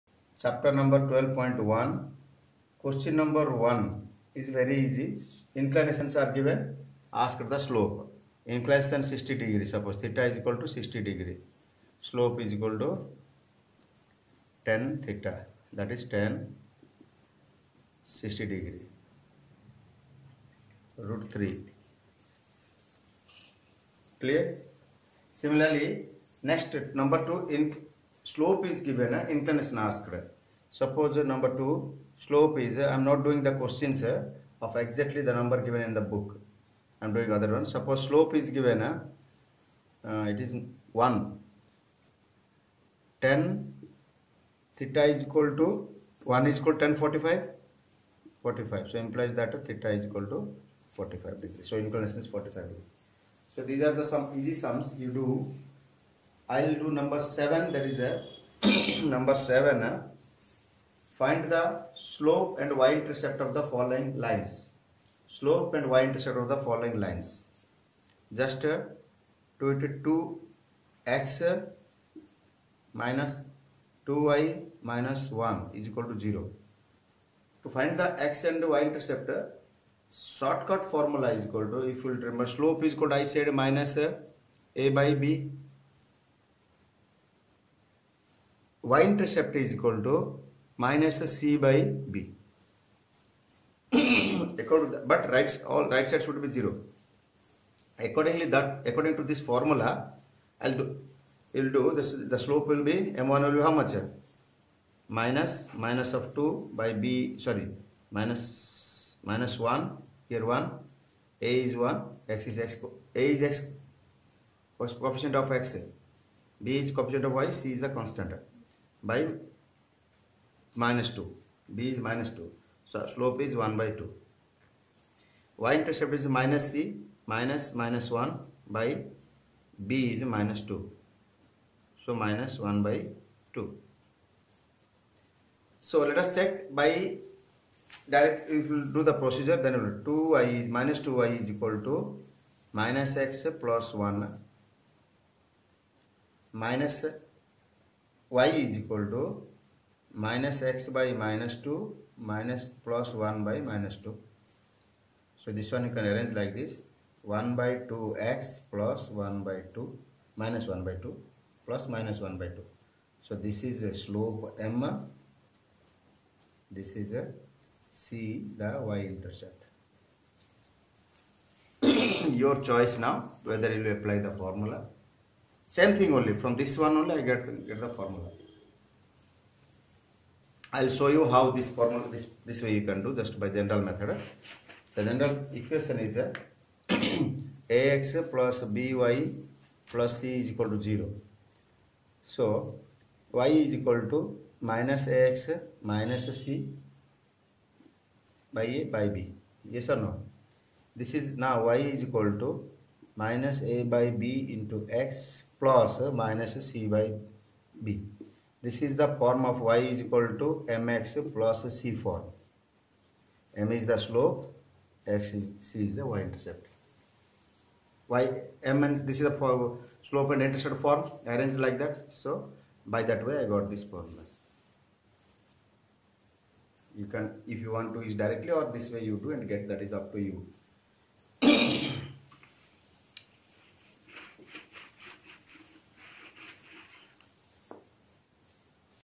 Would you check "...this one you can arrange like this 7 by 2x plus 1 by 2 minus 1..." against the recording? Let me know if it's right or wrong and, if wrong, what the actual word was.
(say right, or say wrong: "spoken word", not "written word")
wrong: "1", not "7".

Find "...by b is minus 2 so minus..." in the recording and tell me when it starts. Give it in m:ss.
2:08.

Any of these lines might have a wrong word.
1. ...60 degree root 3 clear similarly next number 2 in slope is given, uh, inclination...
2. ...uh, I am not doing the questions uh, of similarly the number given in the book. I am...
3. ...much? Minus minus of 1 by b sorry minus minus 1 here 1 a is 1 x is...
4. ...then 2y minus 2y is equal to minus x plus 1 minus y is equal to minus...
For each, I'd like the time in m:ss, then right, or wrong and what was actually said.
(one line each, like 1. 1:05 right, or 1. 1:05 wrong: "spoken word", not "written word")
1. 0:18 right
2. 0:32 wrong: "exactly", not "similarly"
3. 1:43 wrong: "2", not "1"
4. 2:19 right.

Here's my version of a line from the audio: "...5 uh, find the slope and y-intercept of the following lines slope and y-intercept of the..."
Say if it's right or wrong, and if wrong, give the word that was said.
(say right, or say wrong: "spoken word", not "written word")
wrong: "7", not "5".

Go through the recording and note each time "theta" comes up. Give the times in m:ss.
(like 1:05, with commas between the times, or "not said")
0:10, 0:15, 0:44, 0:49.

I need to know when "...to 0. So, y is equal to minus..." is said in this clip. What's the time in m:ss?
3:10.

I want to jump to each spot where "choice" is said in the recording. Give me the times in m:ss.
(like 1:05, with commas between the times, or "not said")
2:52.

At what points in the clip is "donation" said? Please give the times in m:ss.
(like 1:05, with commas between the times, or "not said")
not said.